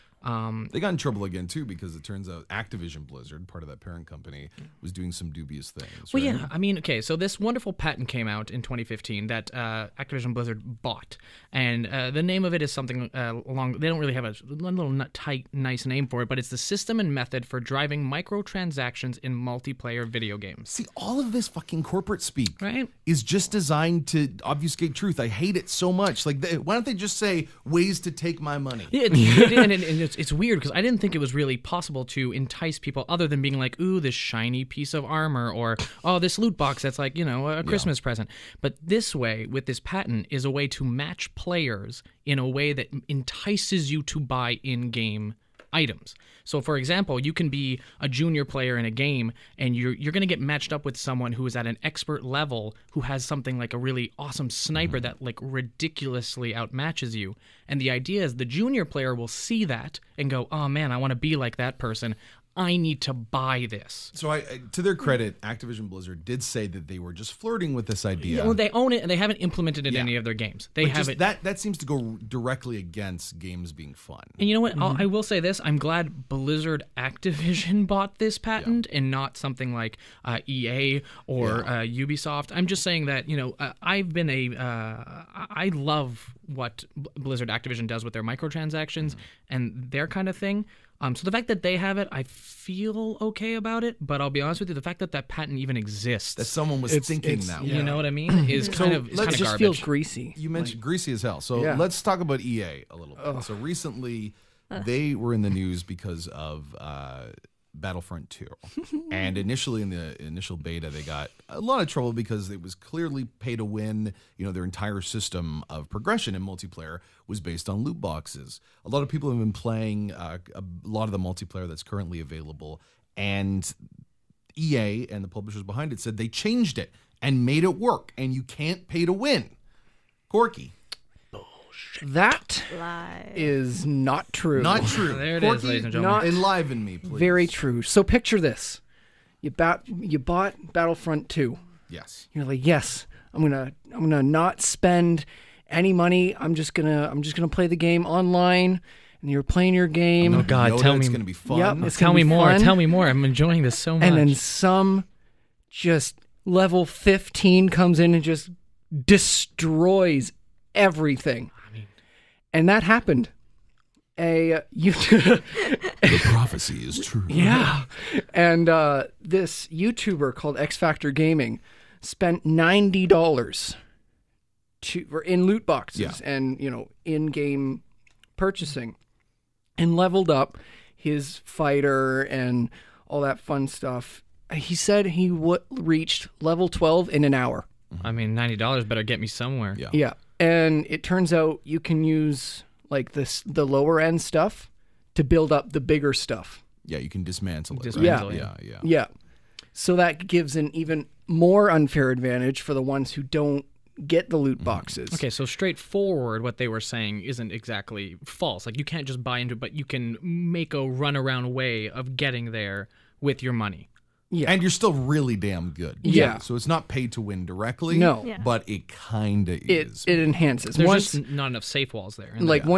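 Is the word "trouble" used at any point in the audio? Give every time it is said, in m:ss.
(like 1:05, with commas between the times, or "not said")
0:00, 1:51.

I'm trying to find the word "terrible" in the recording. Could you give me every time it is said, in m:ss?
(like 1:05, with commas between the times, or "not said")
not said.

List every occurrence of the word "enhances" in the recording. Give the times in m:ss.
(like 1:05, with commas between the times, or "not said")
3:40.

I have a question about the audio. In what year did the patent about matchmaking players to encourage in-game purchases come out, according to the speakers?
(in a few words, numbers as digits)
2015.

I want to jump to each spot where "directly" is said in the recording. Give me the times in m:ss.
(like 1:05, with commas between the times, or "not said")
1:12, 3:37.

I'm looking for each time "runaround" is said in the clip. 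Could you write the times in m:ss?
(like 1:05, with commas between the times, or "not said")
3:30.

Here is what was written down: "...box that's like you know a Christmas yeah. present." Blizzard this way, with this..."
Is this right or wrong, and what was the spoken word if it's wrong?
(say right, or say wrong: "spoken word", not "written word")
wrong: "But", not "Blizzard".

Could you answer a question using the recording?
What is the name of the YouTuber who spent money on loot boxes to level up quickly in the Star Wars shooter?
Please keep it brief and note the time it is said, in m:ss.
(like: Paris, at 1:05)
X Factor Gaming, at 2:50.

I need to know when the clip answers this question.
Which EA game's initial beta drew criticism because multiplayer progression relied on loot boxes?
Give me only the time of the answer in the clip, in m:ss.
1:47.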